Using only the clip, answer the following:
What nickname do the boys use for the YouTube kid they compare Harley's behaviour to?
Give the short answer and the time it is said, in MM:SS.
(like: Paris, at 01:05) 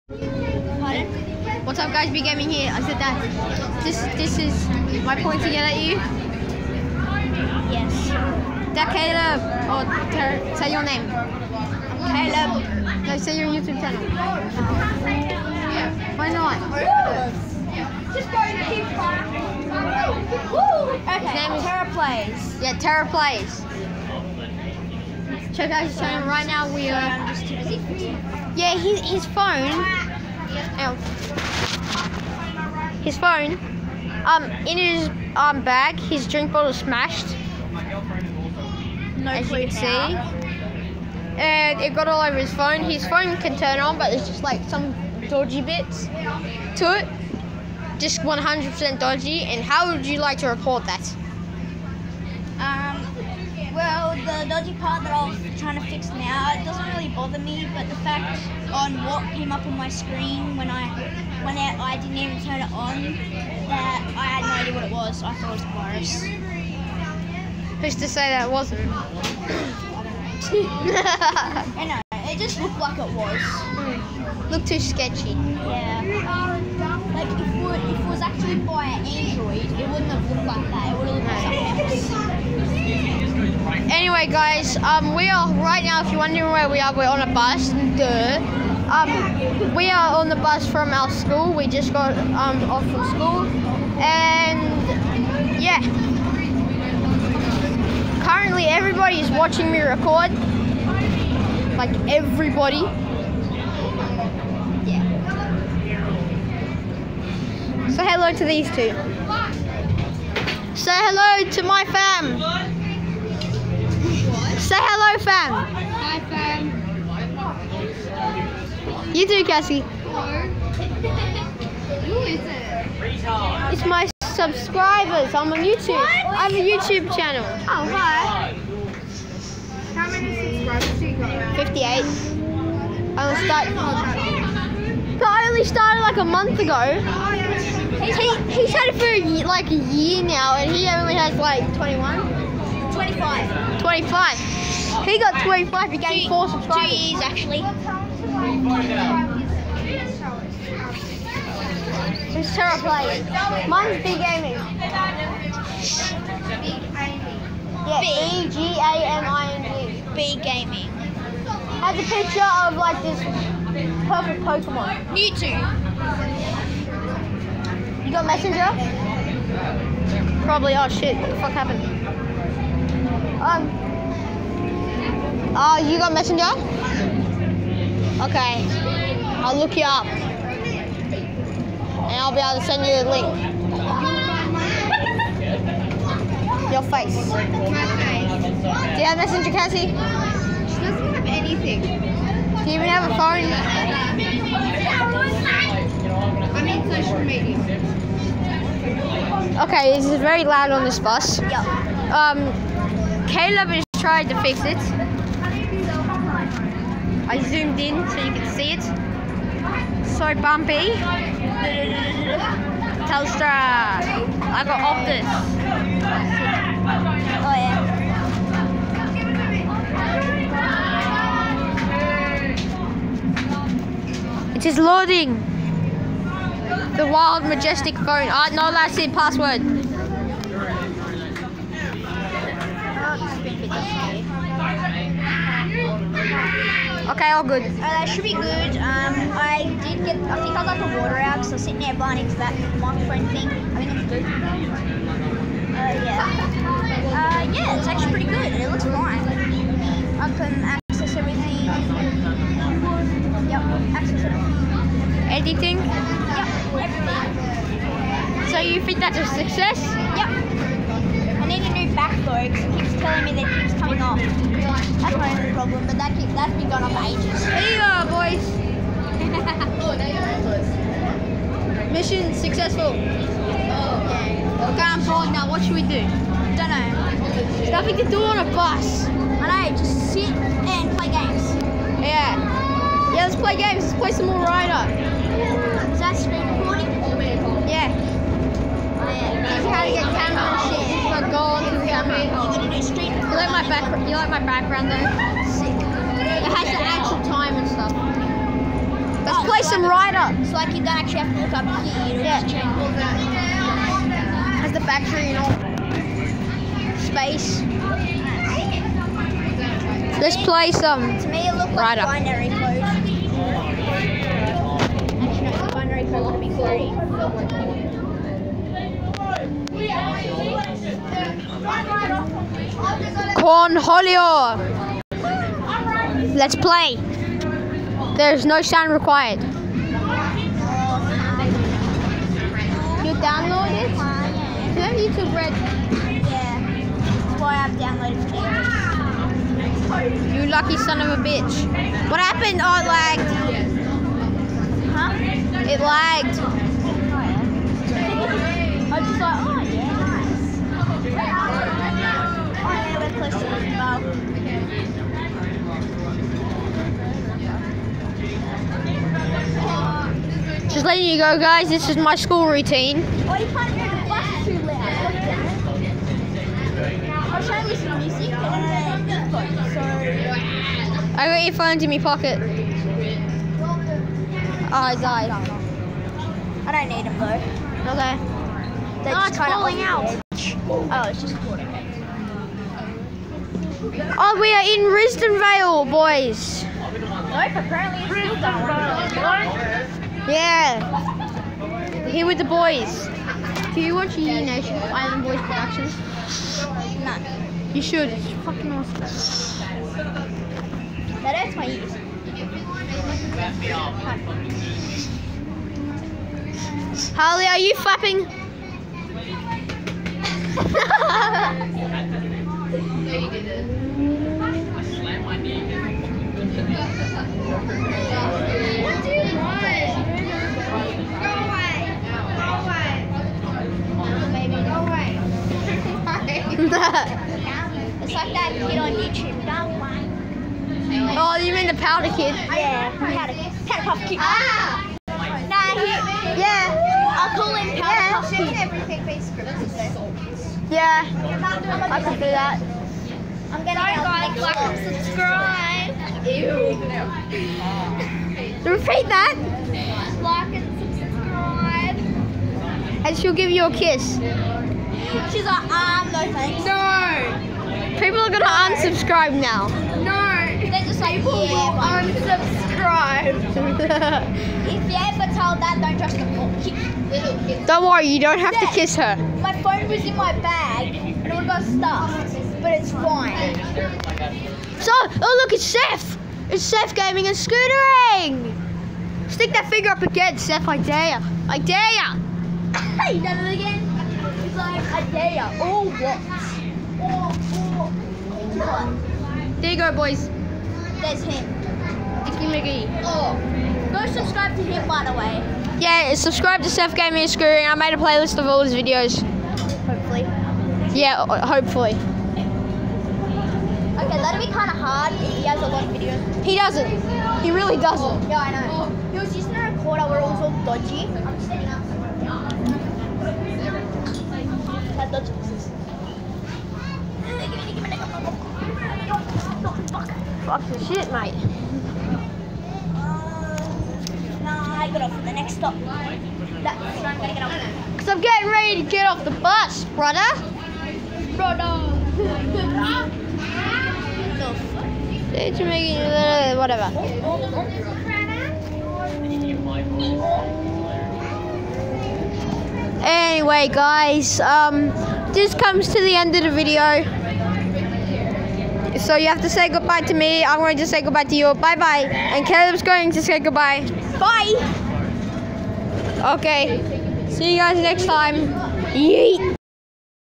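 powder puff kid, at 07:13.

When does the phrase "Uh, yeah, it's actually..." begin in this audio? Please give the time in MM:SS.
04:07.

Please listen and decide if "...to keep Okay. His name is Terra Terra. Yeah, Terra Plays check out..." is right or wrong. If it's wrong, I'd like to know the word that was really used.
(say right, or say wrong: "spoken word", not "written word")
wrong: "Plays", not "Terra".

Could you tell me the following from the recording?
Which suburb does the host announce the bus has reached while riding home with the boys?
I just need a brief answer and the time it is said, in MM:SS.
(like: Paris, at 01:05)
Risdon Vale, at 06:24.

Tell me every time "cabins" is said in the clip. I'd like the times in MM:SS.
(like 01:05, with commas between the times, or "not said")
not said.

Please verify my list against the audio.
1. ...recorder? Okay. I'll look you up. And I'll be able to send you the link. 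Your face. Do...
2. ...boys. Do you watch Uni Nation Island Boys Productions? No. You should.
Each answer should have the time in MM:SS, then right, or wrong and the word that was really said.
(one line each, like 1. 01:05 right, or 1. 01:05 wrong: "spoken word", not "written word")
1. 02:56 wrong: "messenger", not "recorder"
2. 06:32 right.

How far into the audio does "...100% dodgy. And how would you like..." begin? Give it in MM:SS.
00:48.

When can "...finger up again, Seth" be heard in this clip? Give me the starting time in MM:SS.
07:59.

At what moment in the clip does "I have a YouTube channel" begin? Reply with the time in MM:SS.
02:06.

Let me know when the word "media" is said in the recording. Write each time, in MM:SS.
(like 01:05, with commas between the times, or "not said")
03:17.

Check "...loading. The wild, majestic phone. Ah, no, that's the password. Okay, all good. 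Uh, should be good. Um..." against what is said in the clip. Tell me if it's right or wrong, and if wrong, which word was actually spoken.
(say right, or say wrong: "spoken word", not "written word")
right.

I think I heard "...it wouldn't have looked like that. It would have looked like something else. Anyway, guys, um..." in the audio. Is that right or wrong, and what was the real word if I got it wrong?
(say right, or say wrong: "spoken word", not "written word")
right.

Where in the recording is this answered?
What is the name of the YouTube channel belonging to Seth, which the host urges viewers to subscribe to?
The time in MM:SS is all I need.
08:16.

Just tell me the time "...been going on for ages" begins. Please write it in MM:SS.
04:26.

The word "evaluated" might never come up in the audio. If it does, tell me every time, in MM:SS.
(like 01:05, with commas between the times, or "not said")
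not said.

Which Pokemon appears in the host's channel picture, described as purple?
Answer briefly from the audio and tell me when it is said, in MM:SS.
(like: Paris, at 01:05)
Mewtwo, at 02:45.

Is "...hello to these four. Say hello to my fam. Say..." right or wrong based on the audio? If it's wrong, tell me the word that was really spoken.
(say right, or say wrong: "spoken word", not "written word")
wrong: "two", not "four".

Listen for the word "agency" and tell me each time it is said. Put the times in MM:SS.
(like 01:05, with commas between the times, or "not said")
not said.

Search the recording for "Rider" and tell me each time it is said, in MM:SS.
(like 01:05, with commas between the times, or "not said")
04:44, 05:00.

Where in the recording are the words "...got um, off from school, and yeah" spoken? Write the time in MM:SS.
01:31.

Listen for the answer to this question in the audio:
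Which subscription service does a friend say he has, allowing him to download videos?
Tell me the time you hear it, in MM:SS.
05:35.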